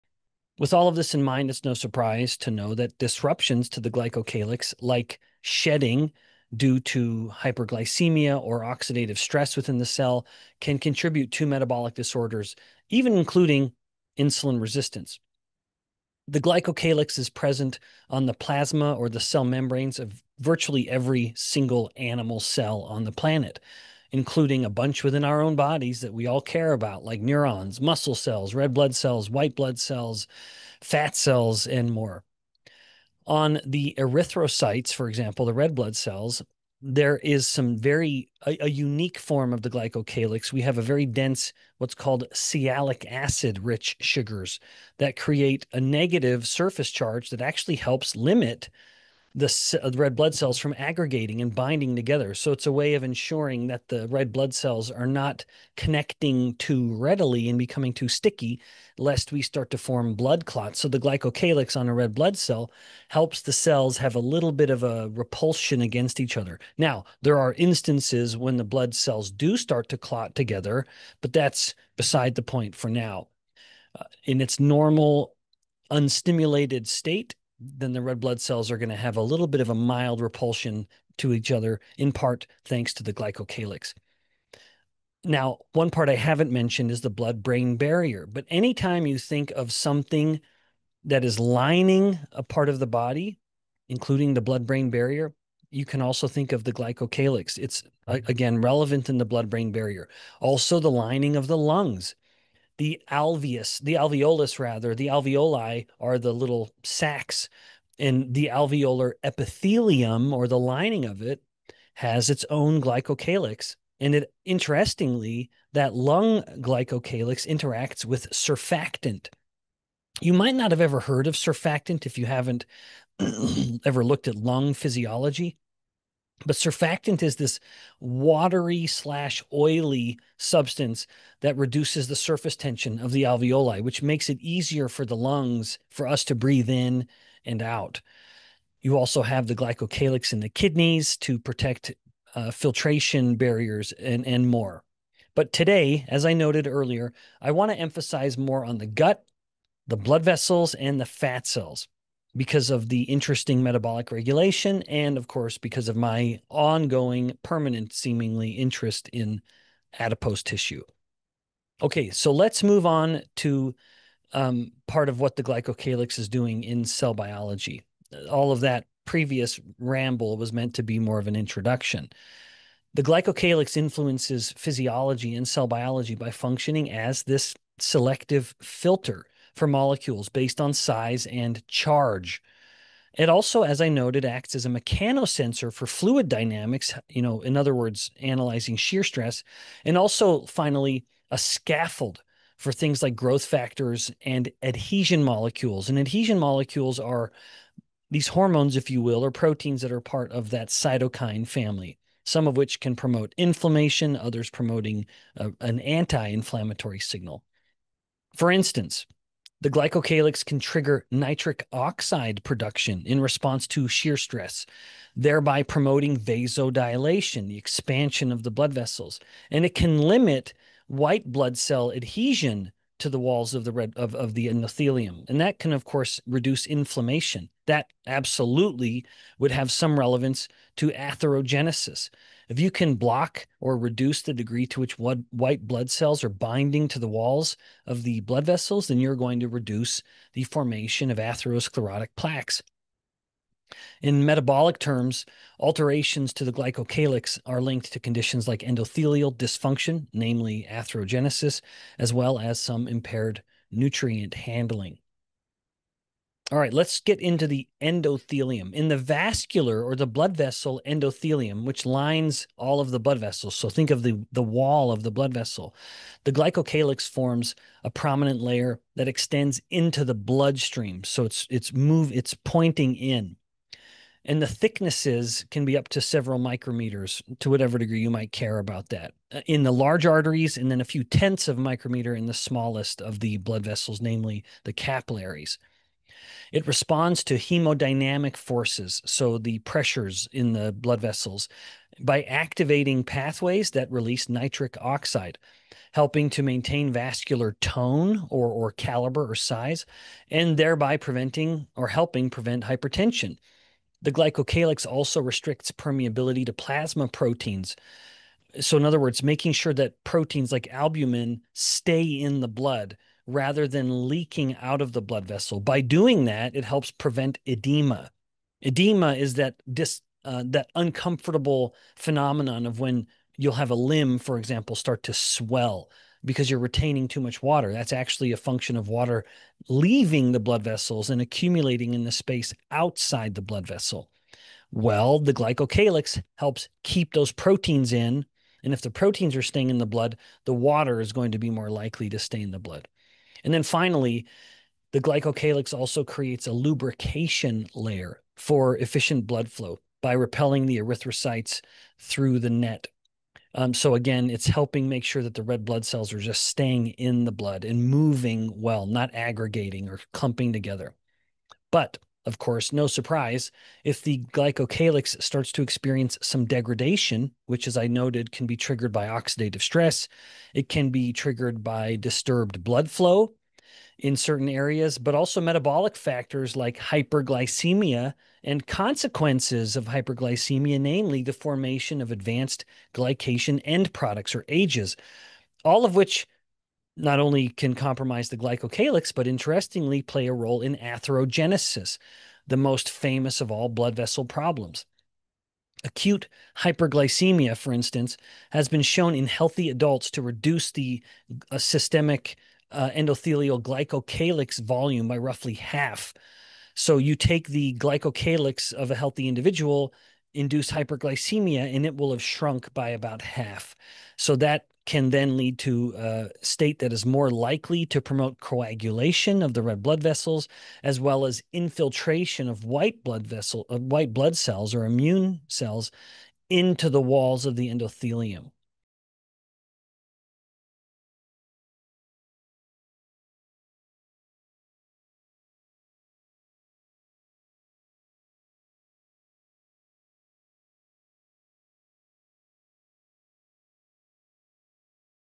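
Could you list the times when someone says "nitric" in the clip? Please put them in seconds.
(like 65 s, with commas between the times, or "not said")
211 s, 294 s.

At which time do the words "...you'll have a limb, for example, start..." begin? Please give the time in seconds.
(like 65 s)
323 s.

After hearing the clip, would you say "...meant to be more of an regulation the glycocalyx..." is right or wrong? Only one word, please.
wrong.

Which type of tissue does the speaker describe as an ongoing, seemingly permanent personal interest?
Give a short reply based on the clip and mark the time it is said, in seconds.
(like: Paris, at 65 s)
adipose tissue, at 159 s.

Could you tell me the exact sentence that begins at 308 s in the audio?
So, in other words, making sure that proteins like albumin stay in the blood rather than leaking out of the blood vessel.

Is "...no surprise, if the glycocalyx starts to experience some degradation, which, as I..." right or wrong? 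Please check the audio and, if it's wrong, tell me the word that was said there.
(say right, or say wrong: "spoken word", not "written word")
right.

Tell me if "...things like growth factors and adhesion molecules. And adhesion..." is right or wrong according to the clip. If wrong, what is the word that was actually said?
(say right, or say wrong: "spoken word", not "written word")
right.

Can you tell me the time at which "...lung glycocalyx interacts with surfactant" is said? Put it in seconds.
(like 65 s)
115 s.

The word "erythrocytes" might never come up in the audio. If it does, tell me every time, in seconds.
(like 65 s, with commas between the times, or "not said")
33 s, 350 s.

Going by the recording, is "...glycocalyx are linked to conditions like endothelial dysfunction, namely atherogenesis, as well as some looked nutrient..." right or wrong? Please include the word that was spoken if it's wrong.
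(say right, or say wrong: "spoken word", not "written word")
wrong: "impaired", not "looked".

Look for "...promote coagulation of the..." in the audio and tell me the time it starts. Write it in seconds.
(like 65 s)
418 s.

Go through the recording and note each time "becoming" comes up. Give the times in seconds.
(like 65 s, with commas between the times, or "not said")
57 s.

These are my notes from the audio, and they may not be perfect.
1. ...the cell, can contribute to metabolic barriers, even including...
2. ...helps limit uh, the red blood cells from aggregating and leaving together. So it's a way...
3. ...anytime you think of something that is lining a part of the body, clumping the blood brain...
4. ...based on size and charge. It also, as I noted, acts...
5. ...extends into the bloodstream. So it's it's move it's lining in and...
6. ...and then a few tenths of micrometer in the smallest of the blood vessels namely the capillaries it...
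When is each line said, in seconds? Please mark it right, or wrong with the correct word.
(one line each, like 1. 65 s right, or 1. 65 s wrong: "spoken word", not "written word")
1. 9 s wrong: "disorders", not "barriers"
2. 47 s wrong: "binding", not "leaving"
3. 88 s wrong: "including", not "clumping"
4. 180 s right
5. 269 s wrong: "pointing", not "lining"
6. 280 s right.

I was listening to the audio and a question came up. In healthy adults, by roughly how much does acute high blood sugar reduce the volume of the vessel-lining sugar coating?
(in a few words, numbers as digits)
about half.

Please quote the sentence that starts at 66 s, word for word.
Now, there are instances when the blood cells do start to clot together, but that's beside the point for now.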